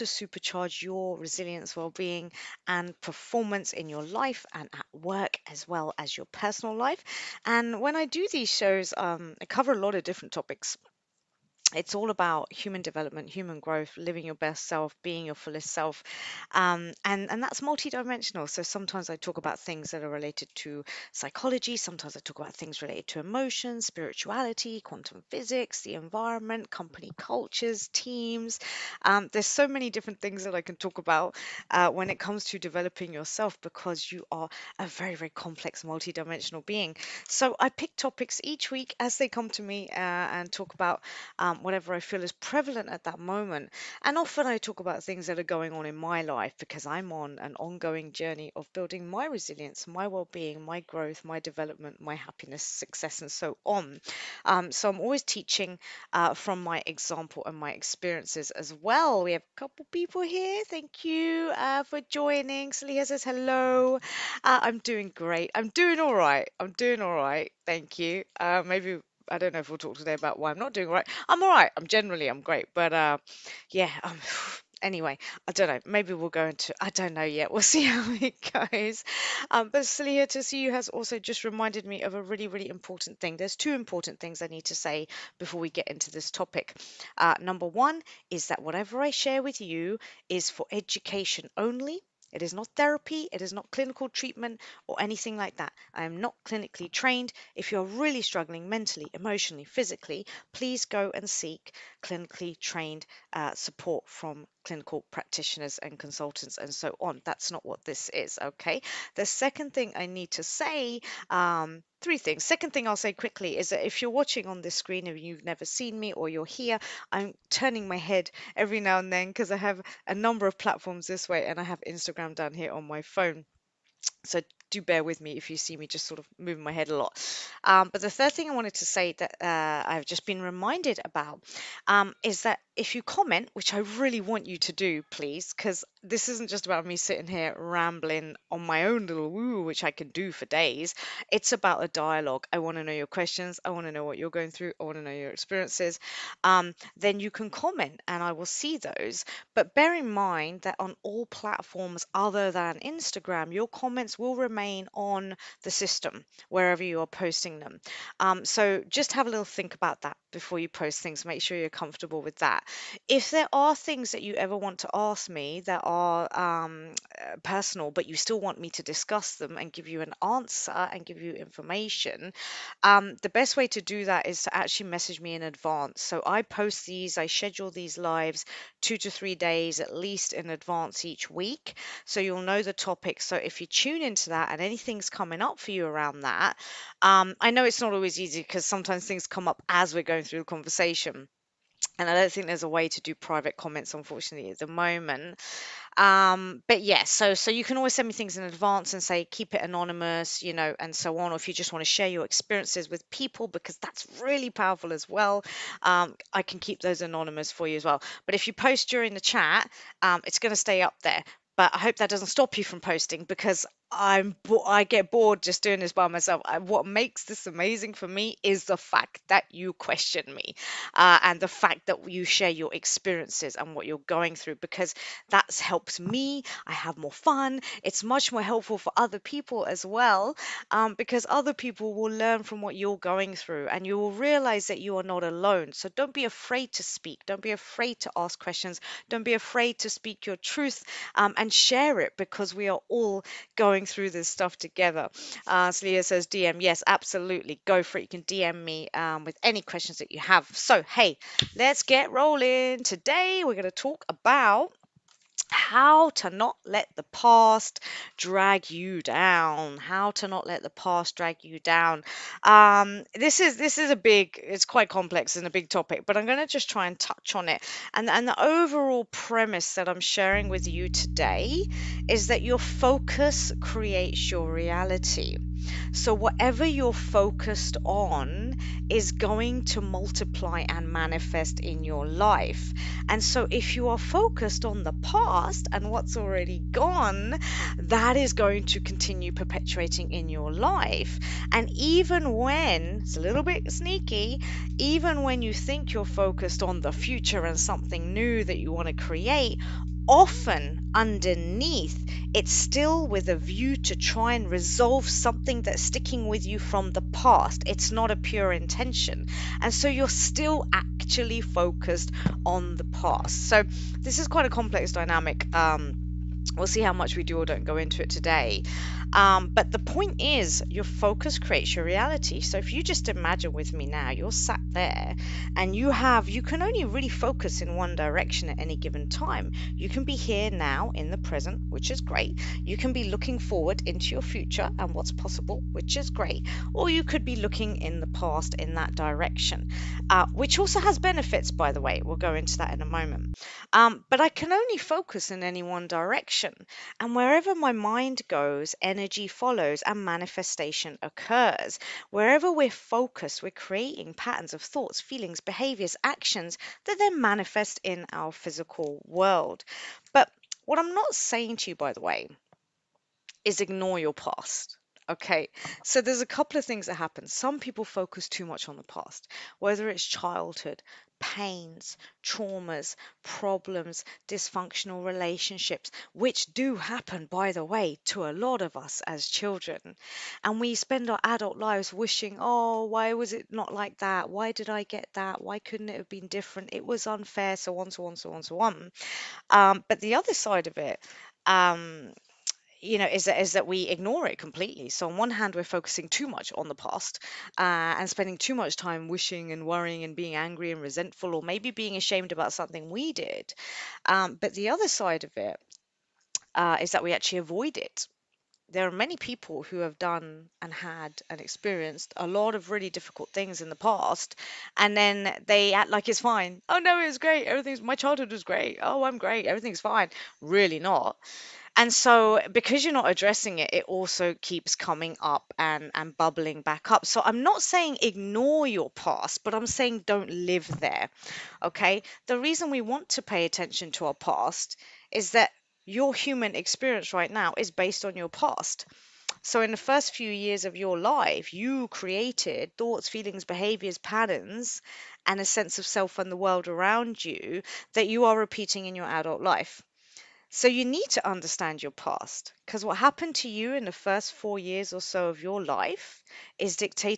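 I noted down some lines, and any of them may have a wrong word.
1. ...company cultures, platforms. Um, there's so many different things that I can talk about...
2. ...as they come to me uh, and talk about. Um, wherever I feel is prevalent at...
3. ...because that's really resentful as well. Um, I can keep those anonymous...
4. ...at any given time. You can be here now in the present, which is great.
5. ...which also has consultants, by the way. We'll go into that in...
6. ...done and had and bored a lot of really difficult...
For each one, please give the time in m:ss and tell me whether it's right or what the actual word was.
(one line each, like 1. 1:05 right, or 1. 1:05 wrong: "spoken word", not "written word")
1. 0:26 wrong: "teams", not "platforms"
2. 0:38 wrong: "whatever", not "wherever"
3. 3:23 wrong: "powerful", not "resentful"
4. 5:28 right
5. 5:40 wrong: "benefits", not "consultants"
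6. 6:49 wrong: "experienced", not "bored".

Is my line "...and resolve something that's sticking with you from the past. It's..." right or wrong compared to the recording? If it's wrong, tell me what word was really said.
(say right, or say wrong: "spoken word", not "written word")
right.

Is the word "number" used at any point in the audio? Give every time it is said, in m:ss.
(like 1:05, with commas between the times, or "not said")
1:27, 2:00.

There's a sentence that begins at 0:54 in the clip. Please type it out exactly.
Um, so I'm always teaching uh, from my example and my experiences as well.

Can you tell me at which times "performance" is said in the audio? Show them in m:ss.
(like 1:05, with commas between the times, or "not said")
0:03.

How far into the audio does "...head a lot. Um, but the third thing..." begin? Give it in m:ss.
2:06.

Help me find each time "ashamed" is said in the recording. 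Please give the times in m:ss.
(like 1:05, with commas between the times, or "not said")
6:41.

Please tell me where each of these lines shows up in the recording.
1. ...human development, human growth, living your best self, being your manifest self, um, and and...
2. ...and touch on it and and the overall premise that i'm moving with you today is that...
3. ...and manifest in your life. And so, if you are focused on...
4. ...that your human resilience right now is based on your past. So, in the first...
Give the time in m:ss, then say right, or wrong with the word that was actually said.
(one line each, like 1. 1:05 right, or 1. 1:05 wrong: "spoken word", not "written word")
1. 0:12 wrong: "fullest", not "manifest"
2. 4:26 wrong: "sharing", not "moving"
3. 4:40 right
4. 7:15 wrong: "experience", not "resilience".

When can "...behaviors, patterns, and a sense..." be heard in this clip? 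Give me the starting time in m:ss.
7:23.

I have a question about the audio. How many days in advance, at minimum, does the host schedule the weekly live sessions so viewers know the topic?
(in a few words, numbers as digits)
2 to 3 days.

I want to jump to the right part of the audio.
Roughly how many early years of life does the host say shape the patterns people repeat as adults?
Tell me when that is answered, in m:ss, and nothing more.
7:34.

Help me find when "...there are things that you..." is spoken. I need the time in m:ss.
2:43.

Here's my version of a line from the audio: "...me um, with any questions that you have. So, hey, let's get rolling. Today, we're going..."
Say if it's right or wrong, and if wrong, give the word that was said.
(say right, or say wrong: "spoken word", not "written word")
right.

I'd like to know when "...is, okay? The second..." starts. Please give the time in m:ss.
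1:48.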